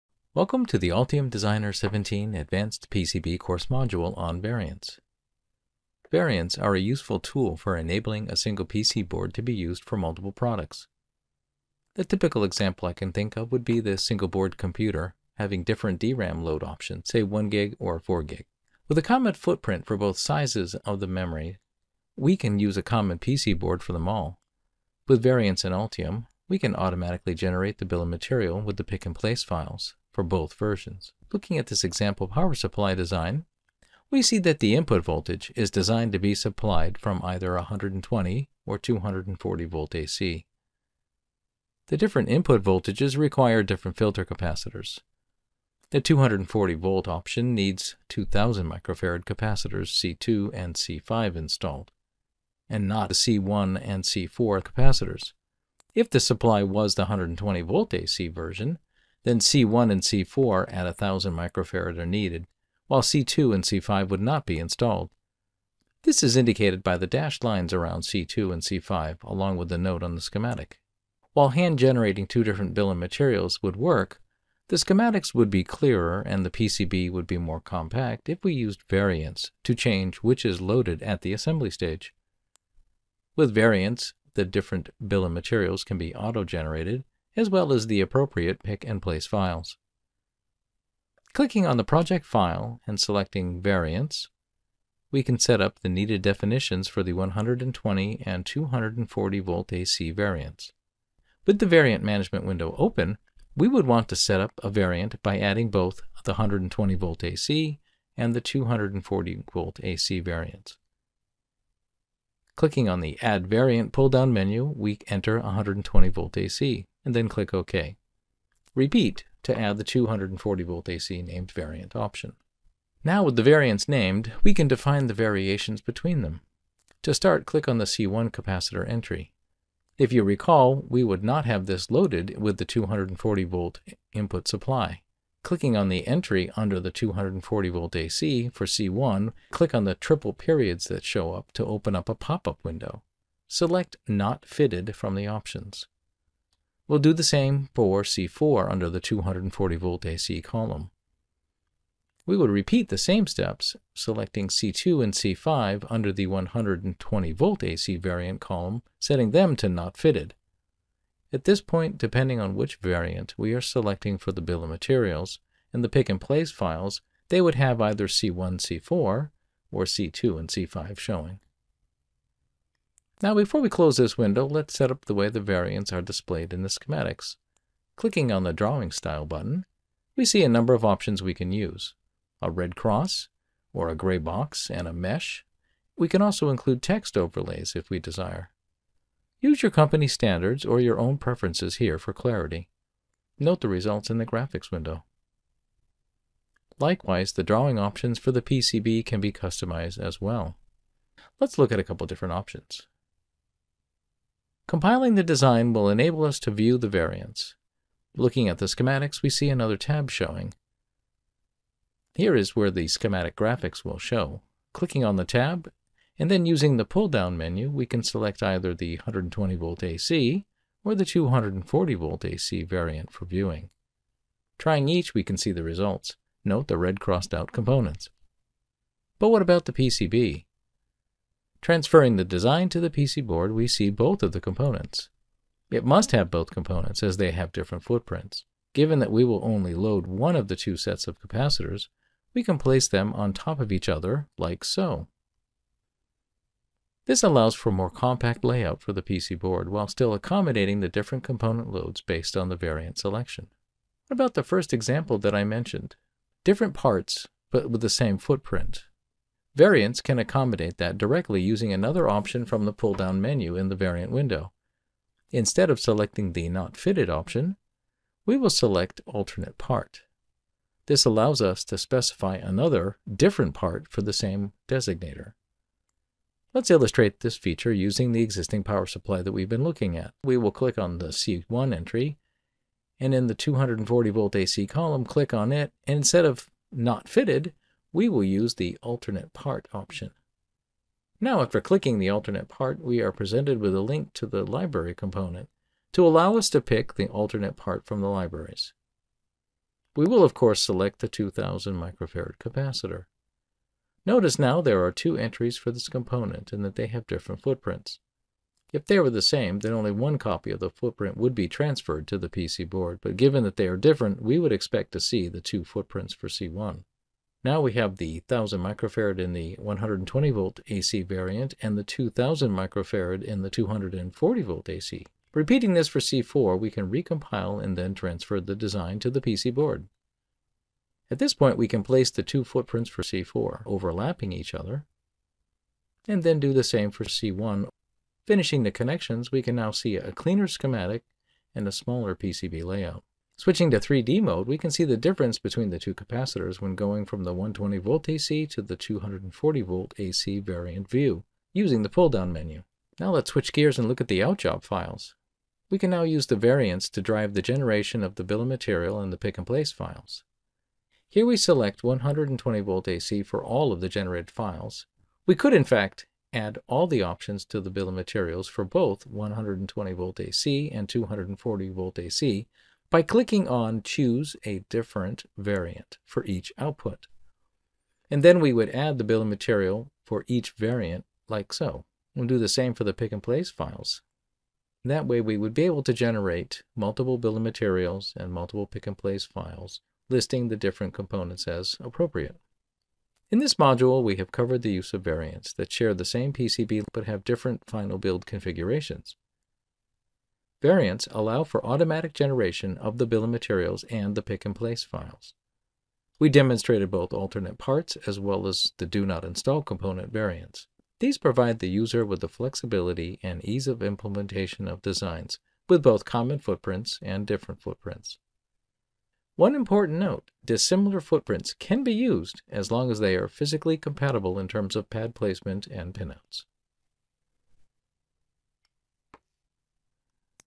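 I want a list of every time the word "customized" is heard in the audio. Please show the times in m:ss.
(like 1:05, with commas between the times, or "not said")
3:19.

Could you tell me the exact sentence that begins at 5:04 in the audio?
Notice now there are two entries for this component and that they have different footprints.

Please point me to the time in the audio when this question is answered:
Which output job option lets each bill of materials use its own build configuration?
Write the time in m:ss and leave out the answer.
6:13.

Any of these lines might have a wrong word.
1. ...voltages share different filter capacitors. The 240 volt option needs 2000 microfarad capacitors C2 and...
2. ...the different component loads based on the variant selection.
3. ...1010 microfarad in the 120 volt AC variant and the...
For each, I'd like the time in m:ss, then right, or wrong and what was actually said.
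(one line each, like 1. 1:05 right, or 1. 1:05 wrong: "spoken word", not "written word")
1. 0:42 wrong: "require", not "share"
2. 4:10 right
3. 5:18 wrong: "1000", not "1010".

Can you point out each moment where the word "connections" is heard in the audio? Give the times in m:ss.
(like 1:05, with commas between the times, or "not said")
5:38.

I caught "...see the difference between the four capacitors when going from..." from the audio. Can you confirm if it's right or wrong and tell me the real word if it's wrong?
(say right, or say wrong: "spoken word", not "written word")
wrong: "two", not "four".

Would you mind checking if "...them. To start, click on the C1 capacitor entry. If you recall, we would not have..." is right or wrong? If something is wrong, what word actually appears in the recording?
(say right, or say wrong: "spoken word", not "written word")
right.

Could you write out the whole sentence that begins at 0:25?
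With variants in Altium, we can automatically generate the bill of material with the pick and place files for both versions.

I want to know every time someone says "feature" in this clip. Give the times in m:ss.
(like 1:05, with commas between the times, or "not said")
4:37.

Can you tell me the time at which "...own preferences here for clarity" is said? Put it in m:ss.
3:10.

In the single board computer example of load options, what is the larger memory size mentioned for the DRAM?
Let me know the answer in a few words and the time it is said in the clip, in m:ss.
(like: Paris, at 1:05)
4 gig, at 0:17.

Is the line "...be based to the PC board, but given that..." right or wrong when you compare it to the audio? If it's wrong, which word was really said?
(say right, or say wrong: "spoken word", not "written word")
wrong: "transferred", not "based".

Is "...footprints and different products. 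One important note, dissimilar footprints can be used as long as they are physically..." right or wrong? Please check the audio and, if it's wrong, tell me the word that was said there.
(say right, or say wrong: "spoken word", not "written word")
wrong: "footprints", not "products".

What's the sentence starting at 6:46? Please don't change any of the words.
We demonstrated both alternate parts as well as the do not install component variants.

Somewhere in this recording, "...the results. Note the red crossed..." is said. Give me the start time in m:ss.
3:45.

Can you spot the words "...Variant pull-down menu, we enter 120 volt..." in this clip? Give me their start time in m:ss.
1:53.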